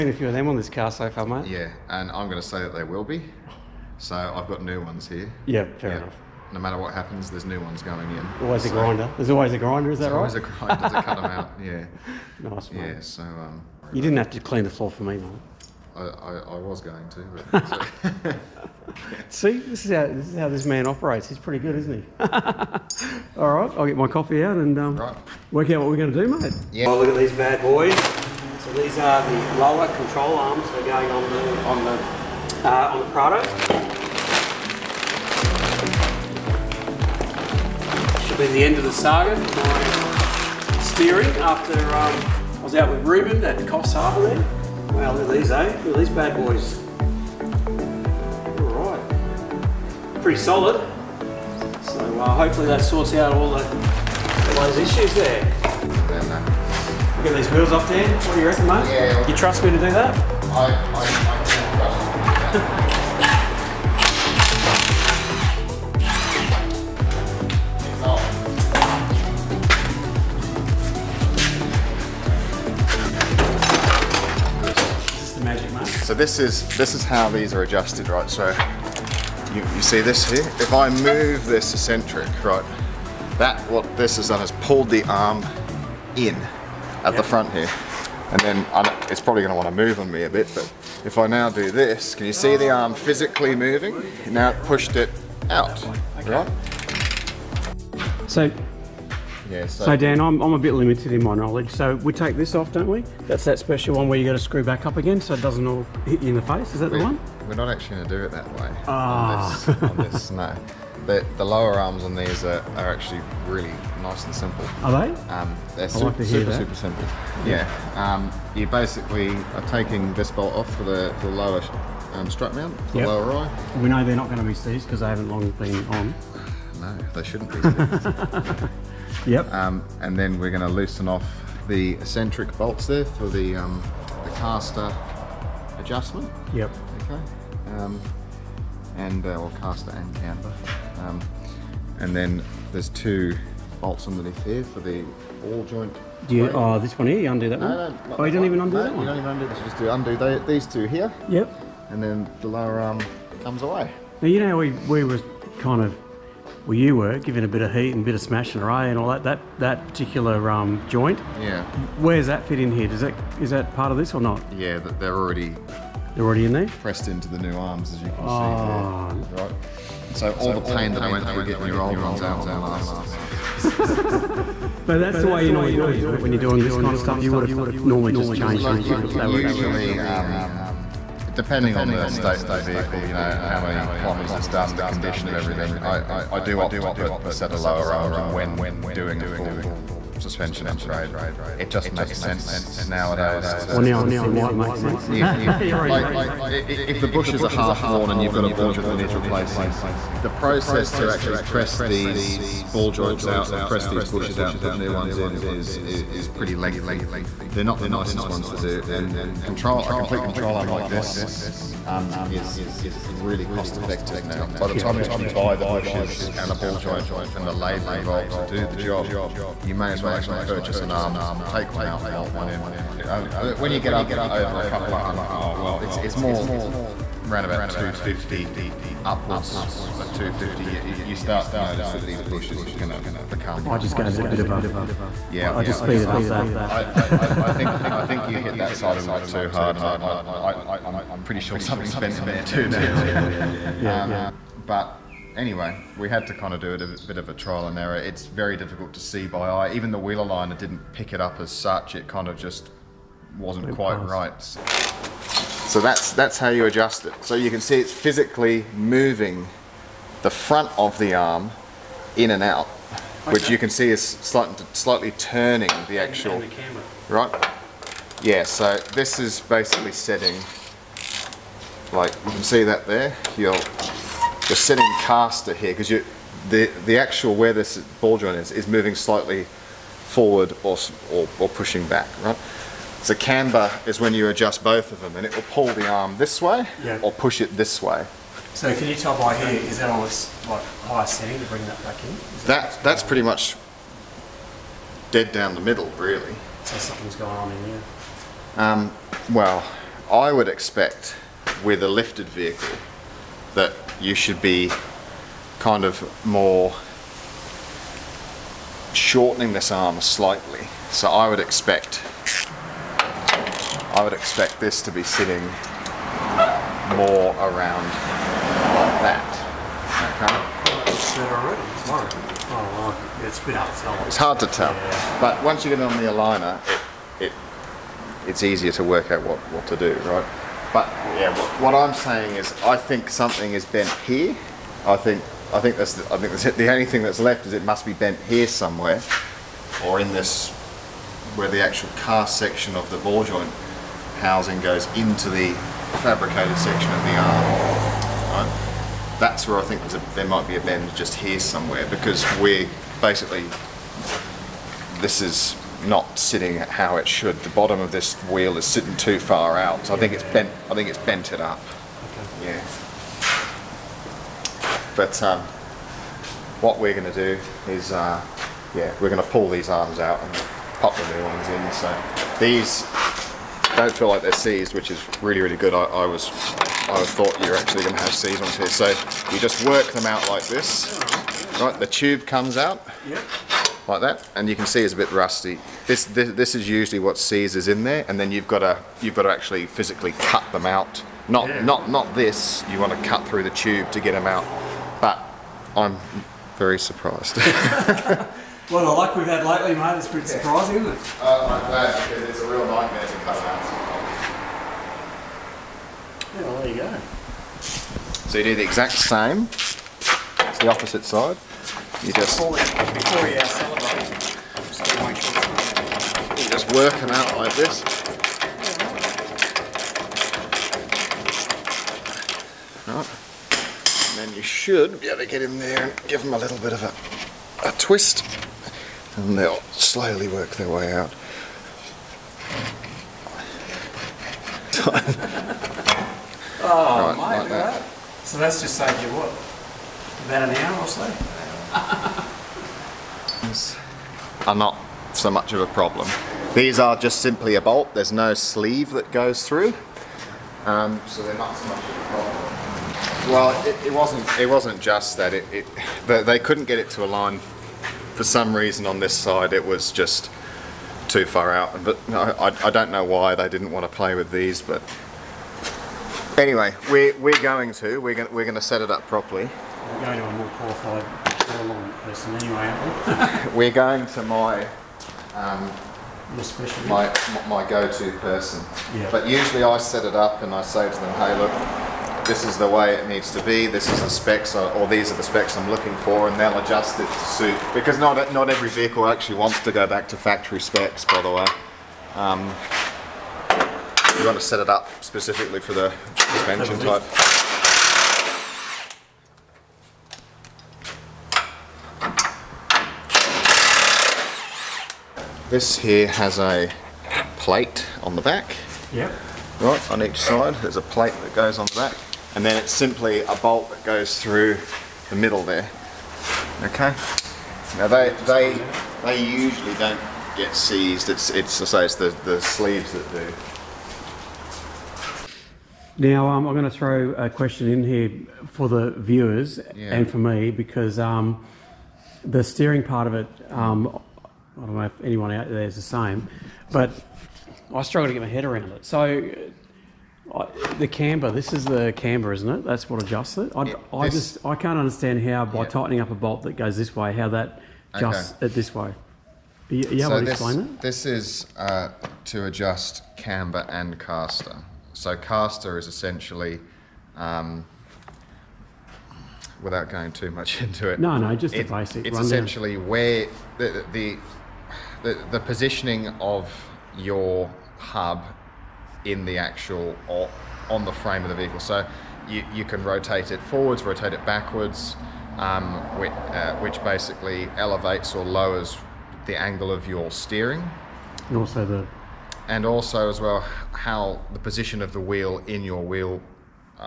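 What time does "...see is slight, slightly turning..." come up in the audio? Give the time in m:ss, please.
4:23.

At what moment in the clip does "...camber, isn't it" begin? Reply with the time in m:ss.
9:01.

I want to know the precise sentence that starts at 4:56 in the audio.
So something's going on in here?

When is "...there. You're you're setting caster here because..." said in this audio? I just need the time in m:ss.
4:32.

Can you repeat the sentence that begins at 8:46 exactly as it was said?
Now, um, I'm going to throw a question in here for the viewers yeah.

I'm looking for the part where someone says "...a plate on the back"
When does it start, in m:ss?
8:26.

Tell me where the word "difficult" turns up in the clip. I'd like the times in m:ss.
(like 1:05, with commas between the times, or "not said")
4:08.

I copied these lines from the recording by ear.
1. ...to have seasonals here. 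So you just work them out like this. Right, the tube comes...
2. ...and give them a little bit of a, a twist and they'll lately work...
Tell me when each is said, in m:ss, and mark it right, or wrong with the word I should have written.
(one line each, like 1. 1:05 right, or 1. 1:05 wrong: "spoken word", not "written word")
1. 6:17 right
2. 7:05 wrong: "slowly", not "lately".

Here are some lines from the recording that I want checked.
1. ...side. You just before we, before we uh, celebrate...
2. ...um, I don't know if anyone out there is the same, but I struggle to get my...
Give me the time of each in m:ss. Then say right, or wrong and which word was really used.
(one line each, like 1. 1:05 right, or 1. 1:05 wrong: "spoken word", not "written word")
1. 6:51 right
2. 8:53 right.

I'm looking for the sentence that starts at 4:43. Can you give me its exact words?
So camber is when you adjust both of them and it will pull the arm this way yeah.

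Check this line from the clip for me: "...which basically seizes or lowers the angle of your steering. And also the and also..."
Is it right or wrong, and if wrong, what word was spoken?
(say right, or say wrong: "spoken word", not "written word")
wrong: "elevates", not "seizes".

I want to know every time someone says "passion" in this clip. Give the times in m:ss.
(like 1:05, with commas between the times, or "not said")
not said.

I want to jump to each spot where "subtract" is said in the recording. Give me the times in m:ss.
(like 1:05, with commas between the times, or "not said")
not said.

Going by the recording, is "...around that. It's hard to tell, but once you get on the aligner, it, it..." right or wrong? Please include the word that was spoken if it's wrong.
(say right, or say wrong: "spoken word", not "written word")
right.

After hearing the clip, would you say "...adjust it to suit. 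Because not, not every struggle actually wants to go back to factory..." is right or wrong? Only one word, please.
wrong.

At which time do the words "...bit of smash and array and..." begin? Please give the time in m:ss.
2:38.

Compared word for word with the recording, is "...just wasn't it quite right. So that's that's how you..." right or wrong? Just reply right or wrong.
right.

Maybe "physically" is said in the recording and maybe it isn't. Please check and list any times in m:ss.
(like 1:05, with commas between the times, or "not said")
1:32, 4:17, 6:29.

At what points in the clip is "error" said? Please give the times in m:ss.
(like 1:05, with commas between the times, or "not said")
4:07.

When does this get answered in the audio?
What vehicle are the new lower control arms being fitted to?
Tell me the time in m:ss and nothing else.
0:33.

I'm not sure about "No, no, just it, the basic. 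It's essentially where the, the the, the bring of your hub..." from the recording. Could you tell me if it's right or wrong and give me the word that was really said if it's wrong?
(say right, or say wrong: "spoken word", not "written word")
wrong: "positioning", not "bring".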